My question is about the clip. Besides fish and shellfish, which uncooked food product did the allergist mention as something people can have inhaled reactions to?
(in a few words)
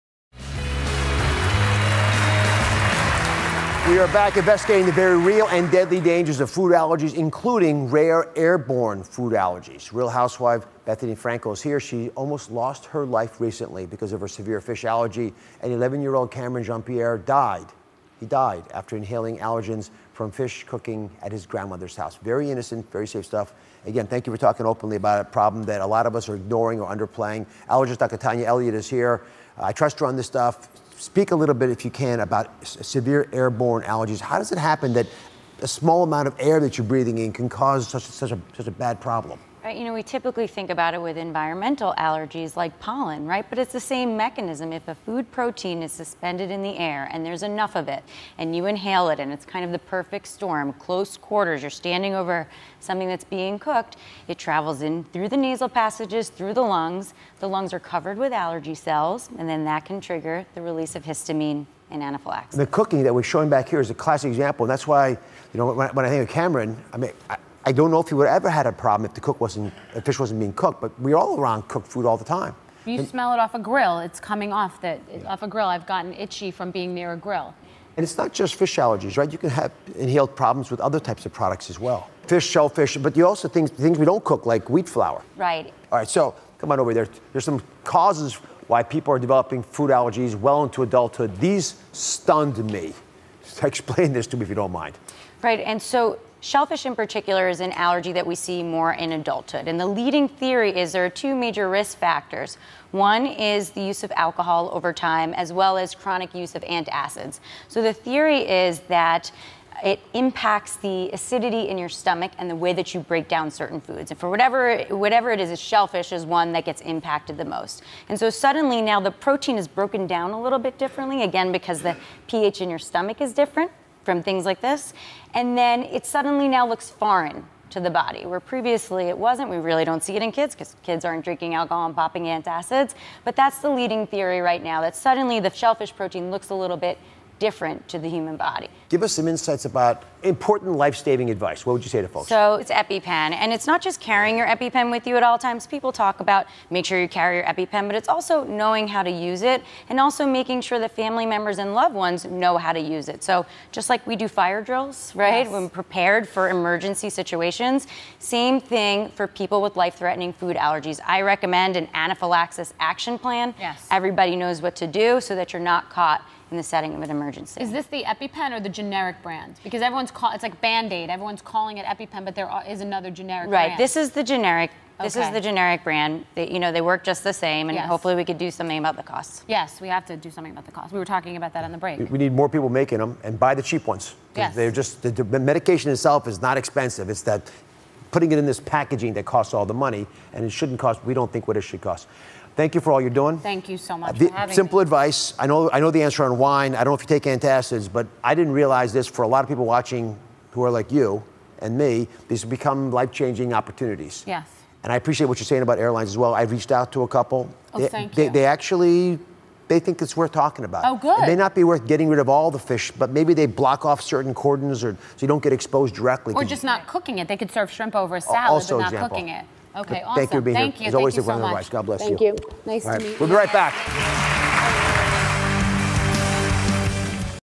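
Wheat flour.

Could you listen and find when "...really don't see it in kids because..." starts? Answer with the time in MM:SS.
02:09.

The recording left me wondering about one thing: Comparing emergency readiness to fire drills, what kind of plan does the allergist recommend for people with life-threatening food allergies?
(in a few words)
Anaphylaxis action plan.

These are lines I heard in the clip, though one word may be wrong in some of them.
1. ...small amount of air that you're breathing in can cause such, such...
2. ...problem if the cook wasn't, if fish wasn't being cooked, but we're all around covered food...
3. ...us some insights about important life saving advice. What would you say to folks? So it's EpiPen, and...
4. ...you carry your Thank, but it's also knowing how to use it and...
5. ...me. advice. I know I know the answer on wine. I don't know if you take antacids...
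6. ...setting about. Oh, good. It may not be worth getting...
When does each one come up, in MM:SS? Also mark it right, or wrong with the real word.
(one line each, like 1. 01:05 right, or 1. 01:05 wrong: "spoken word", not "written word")
1. 00:35 right
2. 01:08 wrong: "cooked", not "covered"
3. 02:19 right
4. 02:27 wrong: "EpiPen", not "Thank"
5. 03:14 right
6. 03:30 wrong: "talking", not "setting".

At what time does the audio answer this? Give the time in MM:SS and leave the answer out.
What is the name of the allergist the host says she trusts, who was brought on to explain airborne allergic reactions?
00:28.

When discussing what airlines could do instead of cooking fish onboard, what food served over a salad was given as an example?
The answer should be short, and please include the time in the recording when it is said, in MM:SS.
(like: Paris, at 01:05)
Shrimp, at 03:37.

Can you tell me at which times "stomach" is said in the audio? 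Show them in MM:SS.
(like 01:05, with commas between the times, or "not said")
01:51, 02:02.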